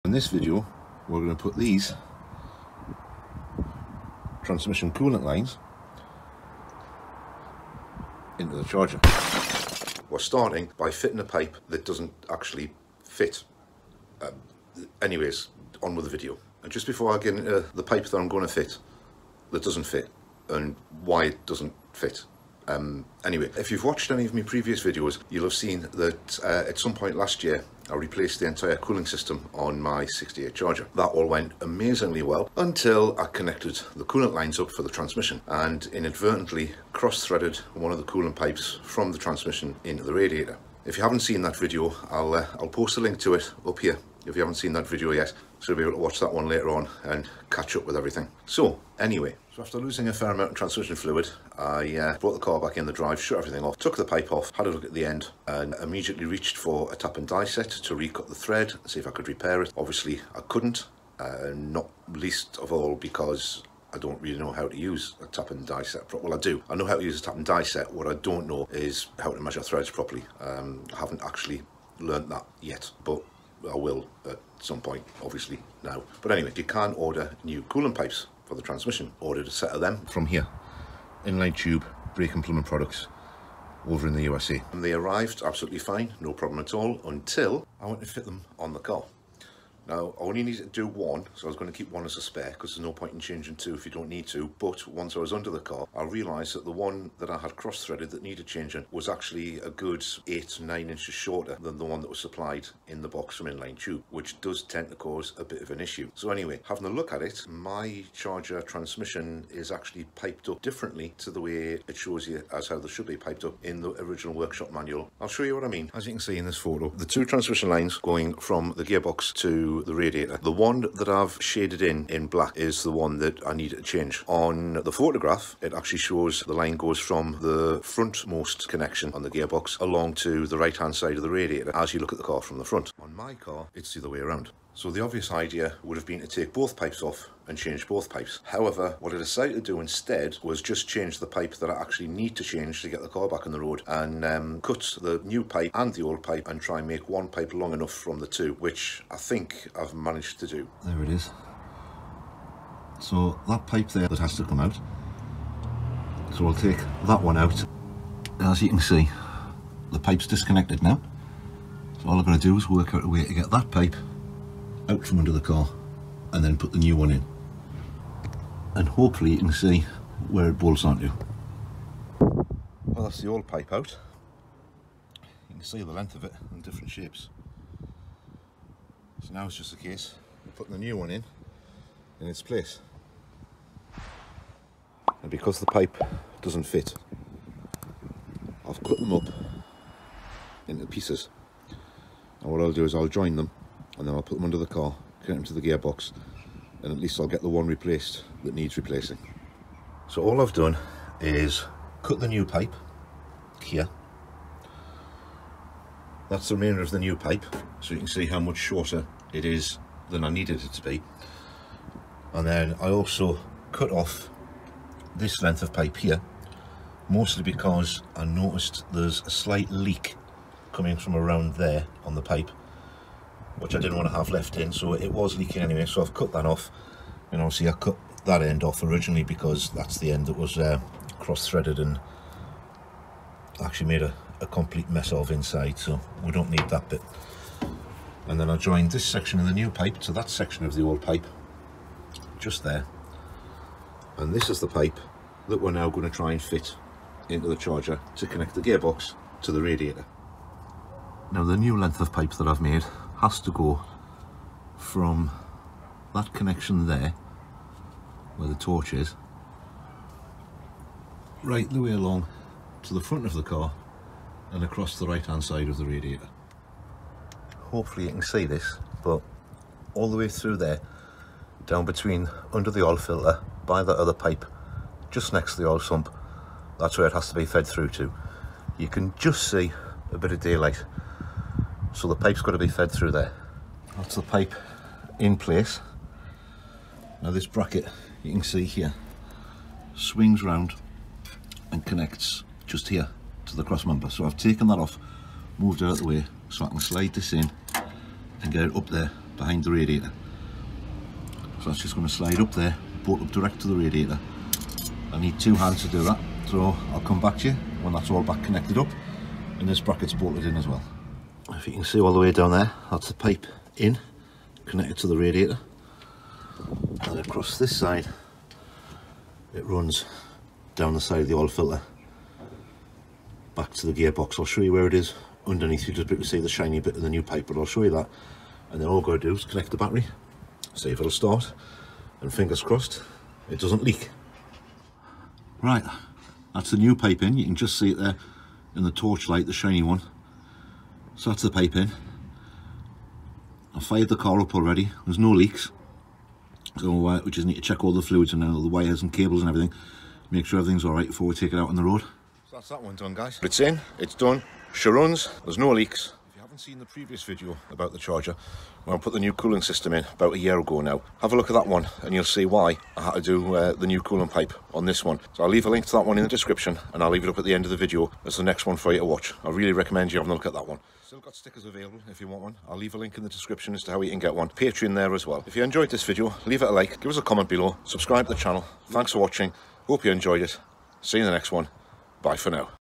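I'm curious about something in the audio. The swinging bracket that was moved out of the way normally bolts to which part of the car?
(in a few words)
Cross member.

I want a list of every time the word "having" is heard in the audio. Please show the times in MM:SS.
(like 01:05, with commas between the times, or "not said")
01:46, 06:10.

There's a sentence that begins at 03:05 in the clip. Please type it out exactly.
And because the pipe doesn't fit, I've cut them up into pieces.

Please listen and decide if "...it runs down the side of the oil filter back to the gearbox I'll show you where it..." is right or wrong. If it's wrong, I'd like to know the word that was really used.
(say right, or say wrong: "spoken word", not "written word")
right.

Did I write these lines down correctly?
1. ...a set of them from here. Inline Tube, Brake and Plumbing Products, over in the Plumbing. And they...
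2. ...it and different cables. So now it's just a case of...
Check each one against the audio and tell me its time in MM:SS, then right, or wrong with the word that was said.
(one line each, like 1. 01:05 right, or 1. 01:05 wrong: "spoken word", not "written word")
1. 01:19 wrong: "USA", not "Plumbing"
2. 02:56 wrong: "shapes", not "cables".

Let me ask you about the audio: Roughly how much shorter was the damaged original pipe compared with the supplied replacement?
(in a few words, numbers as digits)
8 or 9 inches.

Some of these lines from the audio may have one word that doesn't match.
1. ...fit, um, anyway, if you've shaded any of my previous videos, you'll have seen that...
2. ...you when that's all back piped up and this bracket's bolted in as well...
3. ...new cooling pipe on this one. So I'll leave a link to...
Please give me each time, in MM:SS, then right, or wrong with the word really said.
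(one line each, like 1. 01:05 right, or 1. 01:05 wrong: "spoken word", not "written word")
1. 00:21 wrong: "watched", not "shaded"
2. 05:07 wrong: "connected", not "piped"
3. 06:03 right.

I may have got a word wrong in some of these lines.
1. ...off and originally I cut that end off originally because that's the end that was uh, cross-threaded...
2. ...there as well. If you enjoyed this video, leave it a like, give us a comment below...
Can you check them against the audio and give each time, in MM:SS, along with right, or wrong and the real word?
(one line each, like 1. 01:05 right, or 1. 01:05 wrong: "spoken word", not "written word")
1. 03:46 wrong: "obviously", not "originally"
2. 06:14 right.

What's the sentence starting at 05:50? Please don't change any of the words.
Make sure everything's all right before we take it out on the road.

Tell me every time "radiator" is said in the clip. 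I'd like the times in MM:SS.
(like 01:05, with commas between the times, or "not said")
00:40, 01:59, 02:11, 04:09, 04:25, 04:59, 05:03, 05:15.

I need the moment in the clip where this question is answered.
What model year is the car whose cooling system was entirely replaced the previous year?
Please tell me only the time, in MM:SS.
00:30.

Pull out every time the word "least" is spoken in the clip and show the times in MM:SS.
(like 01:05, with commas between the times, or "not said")
01:02, 03:16.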